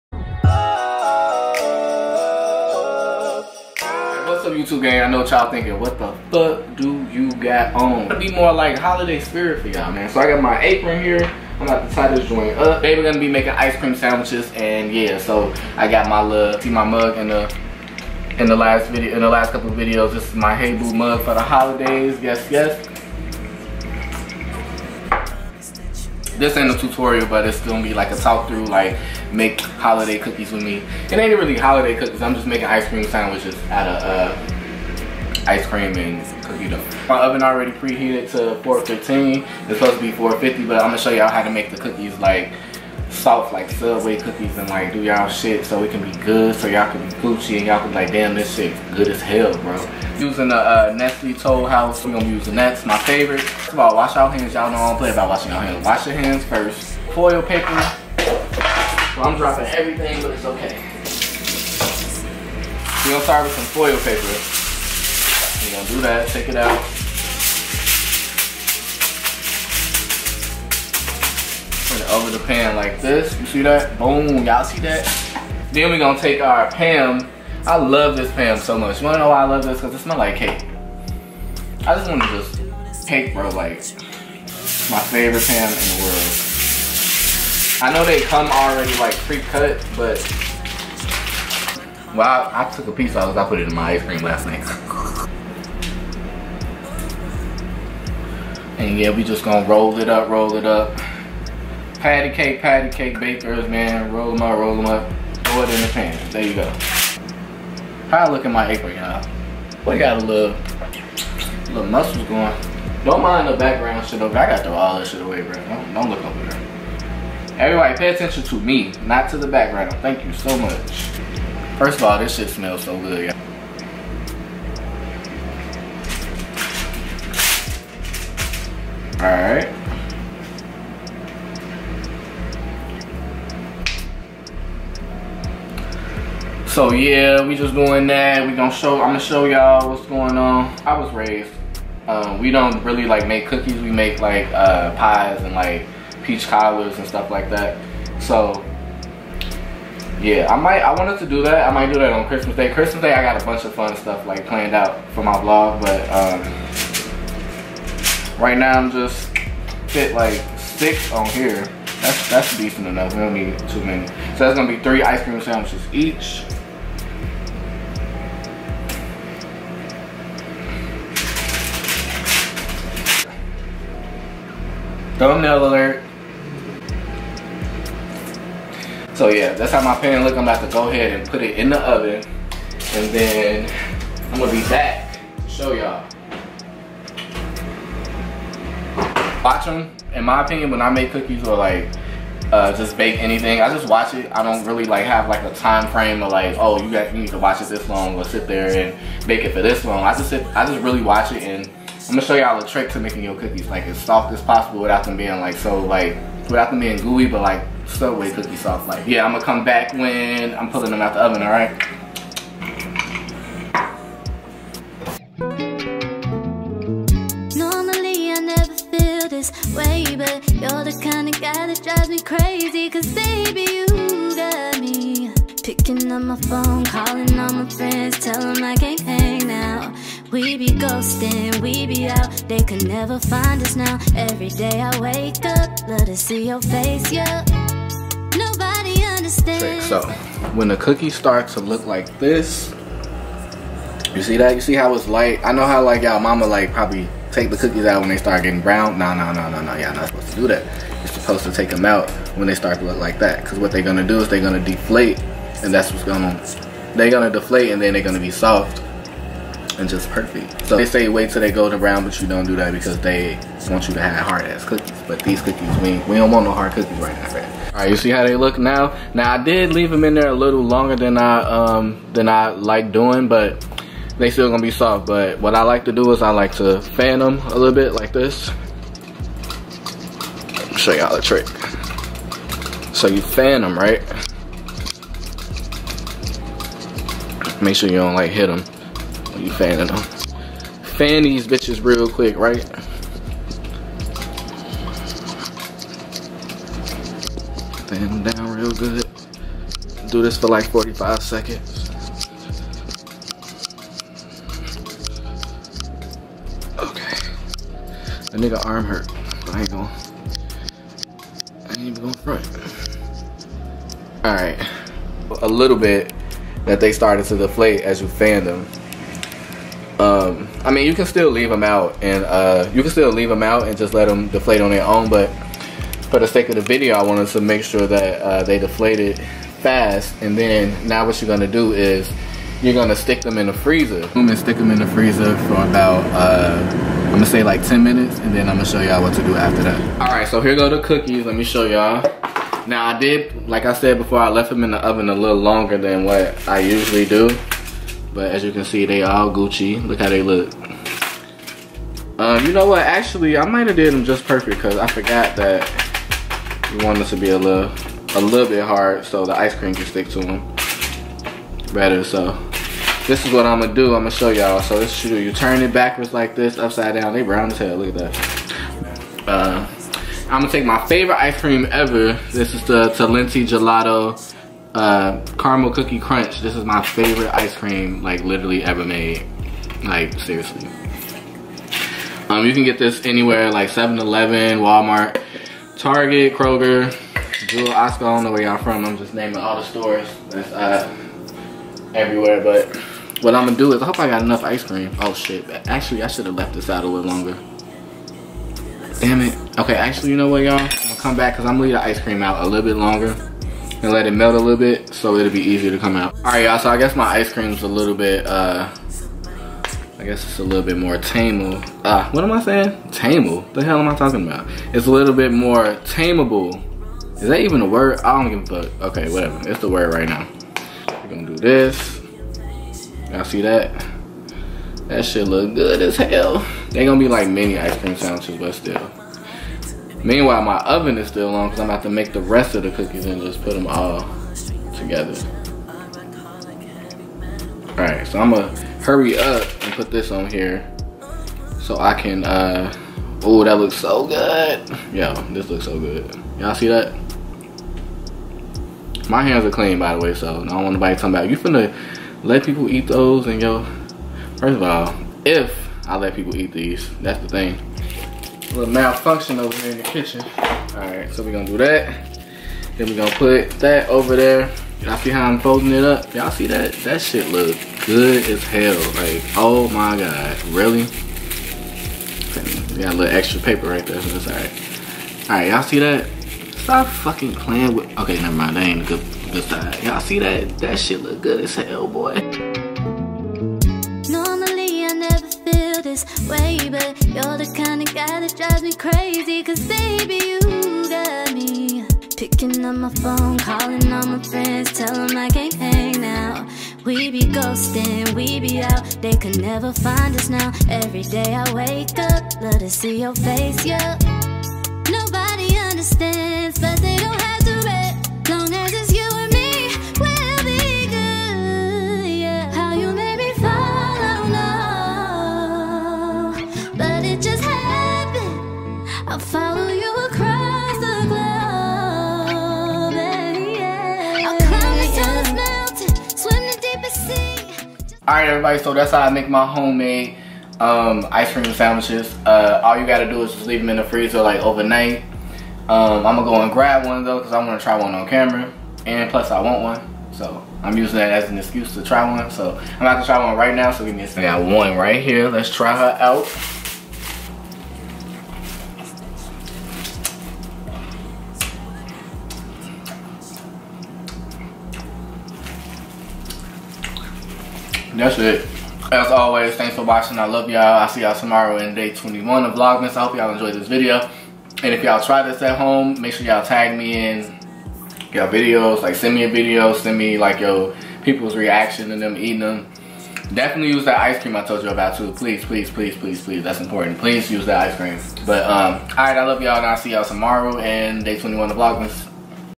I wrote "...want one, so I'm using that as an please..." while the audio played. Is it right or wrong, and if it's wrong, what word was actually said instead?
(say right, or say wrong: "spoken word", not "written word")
wrong: "excuse", not "please".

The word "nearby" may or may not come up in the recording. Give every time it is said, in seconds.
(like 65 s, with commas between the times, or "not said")
not said.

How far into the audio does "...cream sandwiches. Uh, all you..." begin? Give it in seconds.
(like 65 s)
531 s.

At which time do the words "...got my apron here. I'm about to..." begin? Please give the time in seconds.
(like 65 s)
10 s.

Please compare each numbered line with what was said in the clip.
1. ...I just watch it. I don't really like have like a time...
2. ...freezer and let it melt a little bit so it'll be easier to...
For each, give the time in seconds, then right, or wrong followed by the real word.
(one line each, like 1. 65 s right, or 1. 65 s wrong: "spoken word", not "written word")
1. 193 s right
2. 402 s wrong: "longer", not "freezer".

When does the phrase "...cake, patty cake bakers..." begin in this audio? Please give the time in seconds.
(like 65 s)
102 s.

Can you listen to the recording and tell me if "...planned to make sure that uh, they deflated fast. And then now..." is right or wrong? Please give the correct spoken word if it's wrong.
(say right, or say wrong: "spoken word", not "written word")
wrong: "wanted", not "planned".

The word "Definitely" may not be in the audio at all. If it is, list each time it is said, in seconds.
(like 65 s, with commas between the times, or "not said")
573 s.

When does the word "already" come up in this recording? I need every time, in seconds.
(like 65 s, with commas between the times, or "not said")
37 s, 88 s.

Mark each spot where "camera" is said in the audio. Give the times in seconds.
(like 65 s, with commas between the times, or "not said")
538 s.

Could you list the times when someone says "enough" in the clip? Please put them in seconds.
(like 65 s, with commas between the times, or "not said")
162 s, 394 s.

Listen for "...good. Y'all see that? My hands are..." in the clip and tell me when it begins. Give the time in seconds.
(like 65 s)
445 s.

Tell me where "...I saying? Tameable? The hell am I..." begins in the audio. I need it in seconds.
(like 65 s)
412 s.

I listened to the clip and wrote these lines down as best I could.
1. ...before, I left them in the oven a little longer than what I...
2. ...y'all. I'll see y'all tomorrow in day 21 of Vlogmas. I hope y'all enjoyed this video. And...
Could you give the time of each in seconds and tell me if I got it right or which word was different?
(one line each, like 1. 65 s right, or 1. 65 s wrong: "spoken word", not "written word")
1. 343 s right
2. 560 s right.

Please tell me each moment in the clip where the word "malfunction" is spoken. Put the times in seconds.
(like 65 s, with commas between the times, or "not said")
458 s.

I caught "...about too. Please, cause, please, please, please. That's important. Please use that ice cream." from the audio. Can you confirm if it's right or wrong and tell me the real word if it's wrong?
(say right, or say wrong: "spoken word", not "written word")
wrong: "please", not "cause".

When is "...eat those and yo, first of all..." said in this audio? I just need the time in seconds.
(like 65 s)
452 s.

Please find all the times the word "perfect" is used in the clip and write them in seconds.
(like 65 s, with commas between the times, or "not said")
260 s, 354 s.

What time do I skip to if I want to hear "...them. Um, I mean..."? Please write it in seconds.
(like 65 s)
318 s.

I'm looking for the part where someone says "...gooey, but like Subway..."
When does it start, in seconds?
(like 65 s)
206 s.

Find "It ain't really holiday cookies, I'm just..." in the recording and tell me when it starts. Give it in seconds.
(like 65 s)
31 s.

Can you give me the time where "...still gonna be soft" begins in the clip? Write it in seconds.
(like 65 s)
274 s.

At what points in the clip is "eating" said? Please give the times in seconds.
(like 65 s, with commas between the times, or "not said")
572 s.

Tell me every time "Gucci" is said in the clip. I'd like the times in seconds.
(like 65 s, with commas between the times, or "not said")
47 s, 349 s.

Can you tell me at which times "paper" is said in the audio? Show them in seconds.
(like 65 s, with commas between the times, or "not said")
57 s, 63 s, 473 s.